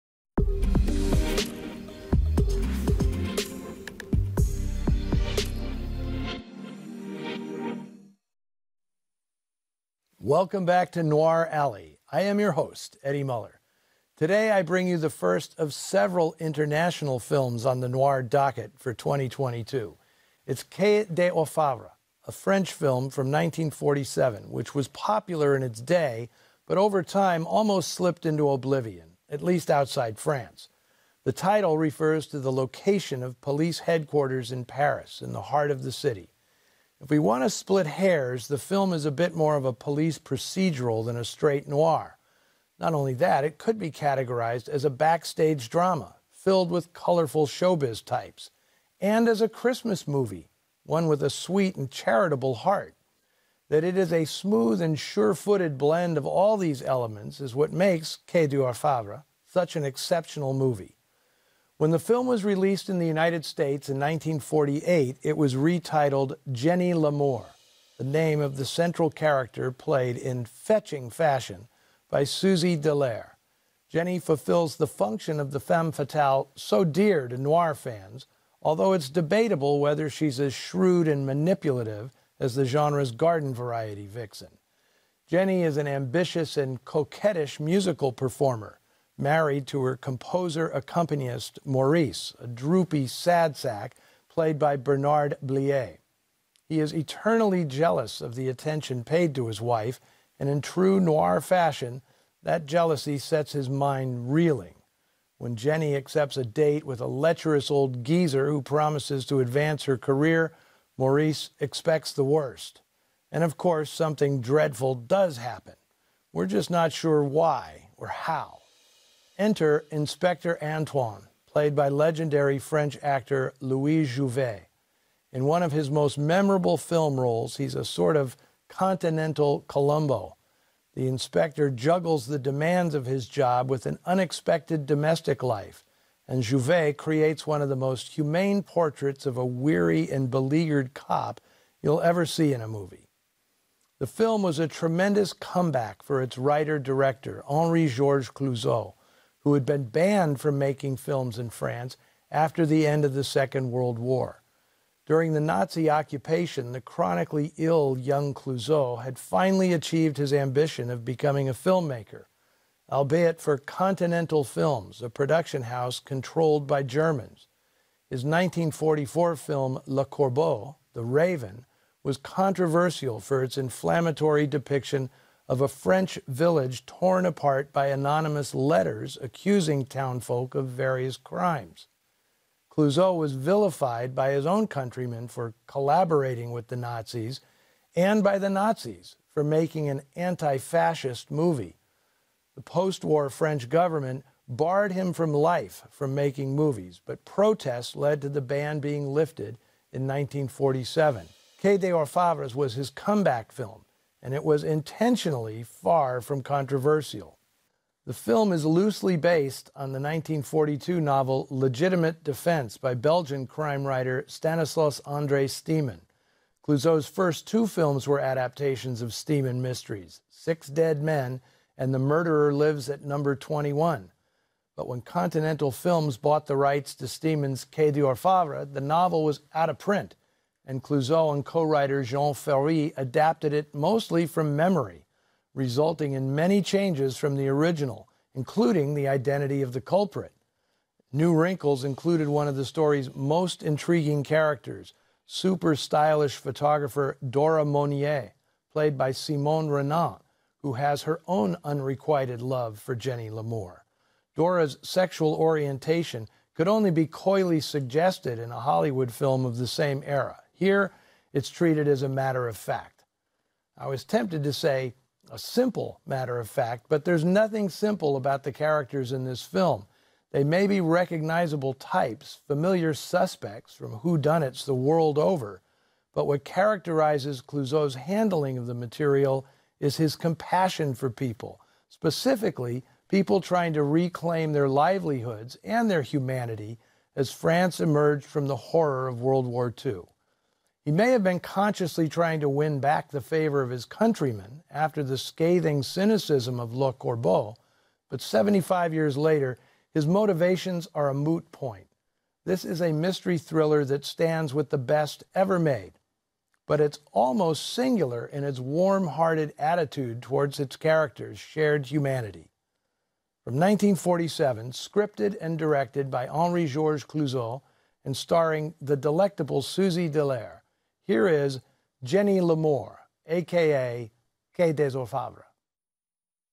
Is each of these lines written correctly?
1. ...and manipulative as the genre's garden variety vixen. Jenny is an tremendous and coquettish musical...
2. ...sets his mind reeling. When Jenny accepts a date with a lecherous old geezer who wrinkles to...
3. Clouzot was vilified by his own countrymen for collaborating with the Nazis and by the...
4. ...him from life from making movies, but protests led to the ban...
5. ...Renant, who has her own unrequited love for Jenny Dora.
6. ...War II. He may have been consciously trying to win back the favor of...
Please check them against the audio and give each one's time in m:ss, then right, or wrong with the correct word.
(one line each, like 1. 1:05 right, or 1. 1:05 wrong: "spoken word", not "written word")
1. 1:21 wrong: "ambitious", not "tremendous"
2. 1:43 wrong: "promises", not "wrinkles"
3. 3:02 right
4. 3:14 right
5. 4:09 wrong: "Lamour", not "Dora"
6. 4:49 right.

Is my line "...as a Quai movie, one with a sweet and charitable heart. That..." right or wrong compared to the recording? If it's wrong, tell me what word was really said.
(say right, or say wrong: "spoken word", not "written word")
wrong: "Christmas", not "Quai".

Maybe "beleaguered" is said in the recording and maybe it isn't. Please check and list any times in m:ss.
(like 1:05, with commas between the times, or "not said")
2:20.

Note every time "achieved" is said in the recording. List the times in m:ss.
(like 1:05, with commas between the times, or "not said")
2:39.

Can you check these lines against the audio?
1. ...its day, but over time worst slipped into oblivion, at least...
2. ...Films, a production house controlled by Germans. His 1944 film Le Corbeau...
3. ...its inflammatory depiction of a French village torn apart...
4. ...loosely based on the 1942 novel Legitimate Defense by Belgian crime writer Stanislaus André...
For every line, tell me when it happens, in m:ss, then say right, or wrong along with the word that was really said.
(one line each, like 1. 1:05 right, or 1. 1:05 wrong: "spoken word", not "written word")
1. 0:25 wrong: "almost", not "worst"
2. 2:44 right
3. 2:53 right
4. 3:28 right.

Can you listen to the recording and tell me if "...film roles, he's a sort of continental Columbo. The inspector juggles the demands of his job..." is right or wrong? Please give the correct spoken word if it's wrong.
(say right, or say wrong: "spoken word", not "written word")
right.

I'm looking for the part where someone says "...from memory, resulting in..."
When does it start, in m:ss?
3:54.